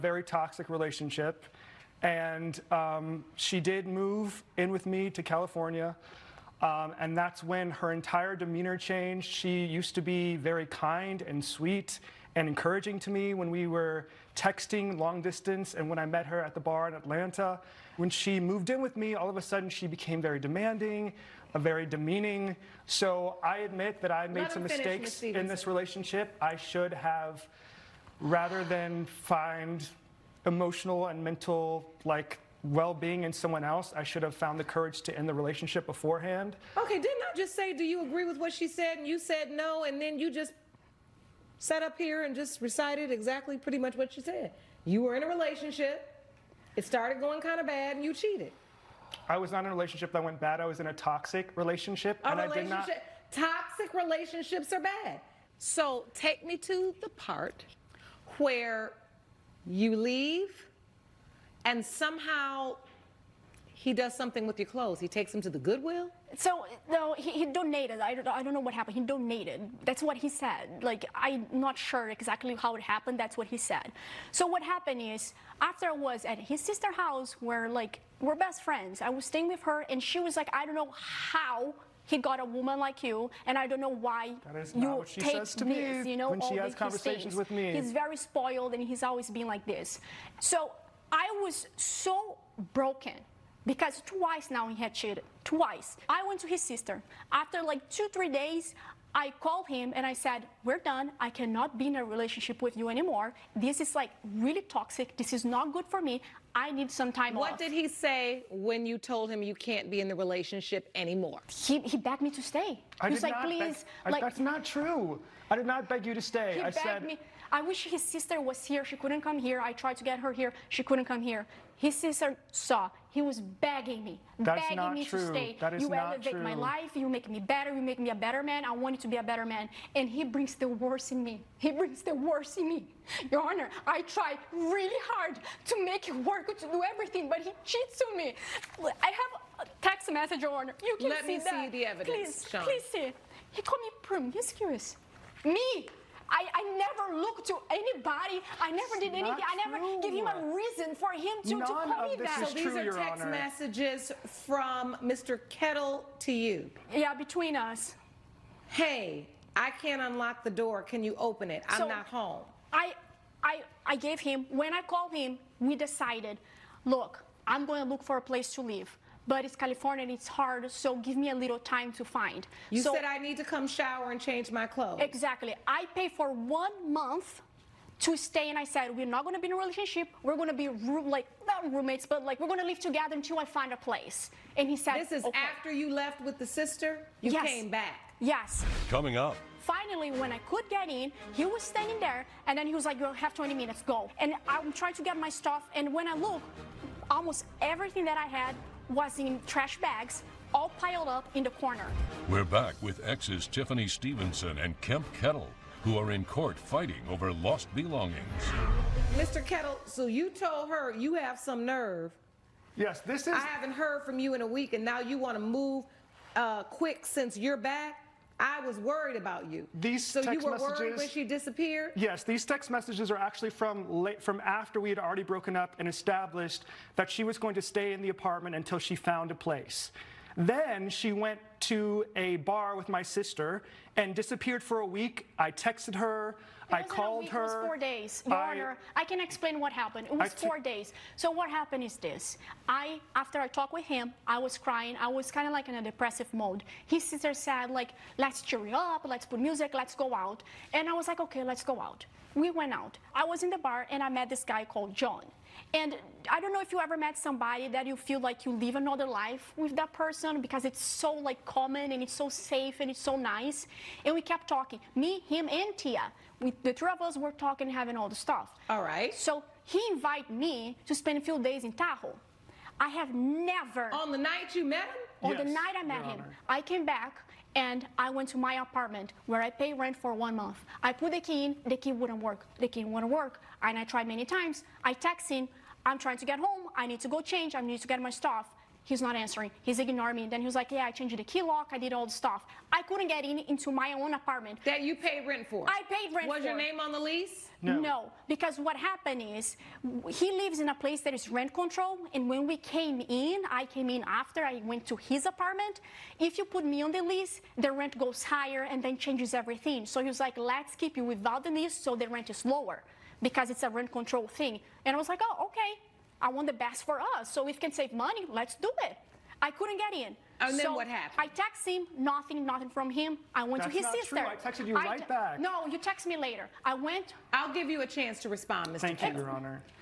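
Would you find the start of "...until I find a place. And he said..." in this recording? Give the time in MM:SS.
03:03.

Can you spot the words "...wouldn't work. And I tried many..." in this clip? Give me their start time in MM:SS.
04:42.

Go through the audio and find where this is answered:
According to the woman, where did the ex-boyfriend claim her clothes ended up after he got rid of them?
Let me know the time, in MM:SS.
01:05.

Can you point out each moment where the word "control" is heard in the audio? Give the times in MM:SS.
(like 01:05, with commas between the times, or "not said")
05:01, 05:13.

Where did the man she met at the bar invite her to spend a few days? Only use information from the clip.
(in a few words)
Tahoe.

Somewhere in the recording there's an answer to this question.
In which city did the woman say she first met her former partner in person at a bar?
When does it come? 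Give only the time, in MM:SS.
00:16.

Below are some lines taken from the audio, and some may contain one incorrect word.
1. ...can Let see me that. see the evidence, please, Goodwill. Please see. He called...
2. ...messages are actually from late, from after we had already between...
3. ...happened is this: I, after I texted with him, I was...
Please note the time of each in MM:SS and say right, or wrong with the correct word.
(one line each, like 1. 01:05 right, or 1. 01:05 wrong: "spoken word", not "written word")
1. 02:20 wrong: "Sean", not "Goodwill"
2. 03:42 wrong: "broken", not "between"
3. 04:01 wrong: "talked", not "texted".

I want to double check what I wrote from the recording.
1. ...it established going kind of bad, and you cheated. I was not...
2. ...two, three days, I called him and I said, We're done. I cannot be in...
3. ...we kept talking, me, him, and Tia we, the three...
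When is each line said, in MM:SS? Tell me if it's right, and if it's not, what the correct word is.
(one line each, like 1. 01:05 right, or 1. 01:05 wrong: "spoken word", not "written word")
1. 00:46 wrong: "started", not "established"
2. 01:37 right
3. 04:24 right.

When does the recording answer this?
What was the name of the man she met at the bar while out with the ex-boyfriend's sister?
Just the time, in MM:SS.
04:14.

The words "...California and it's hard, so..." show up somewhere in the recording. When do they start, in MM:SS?
02:49.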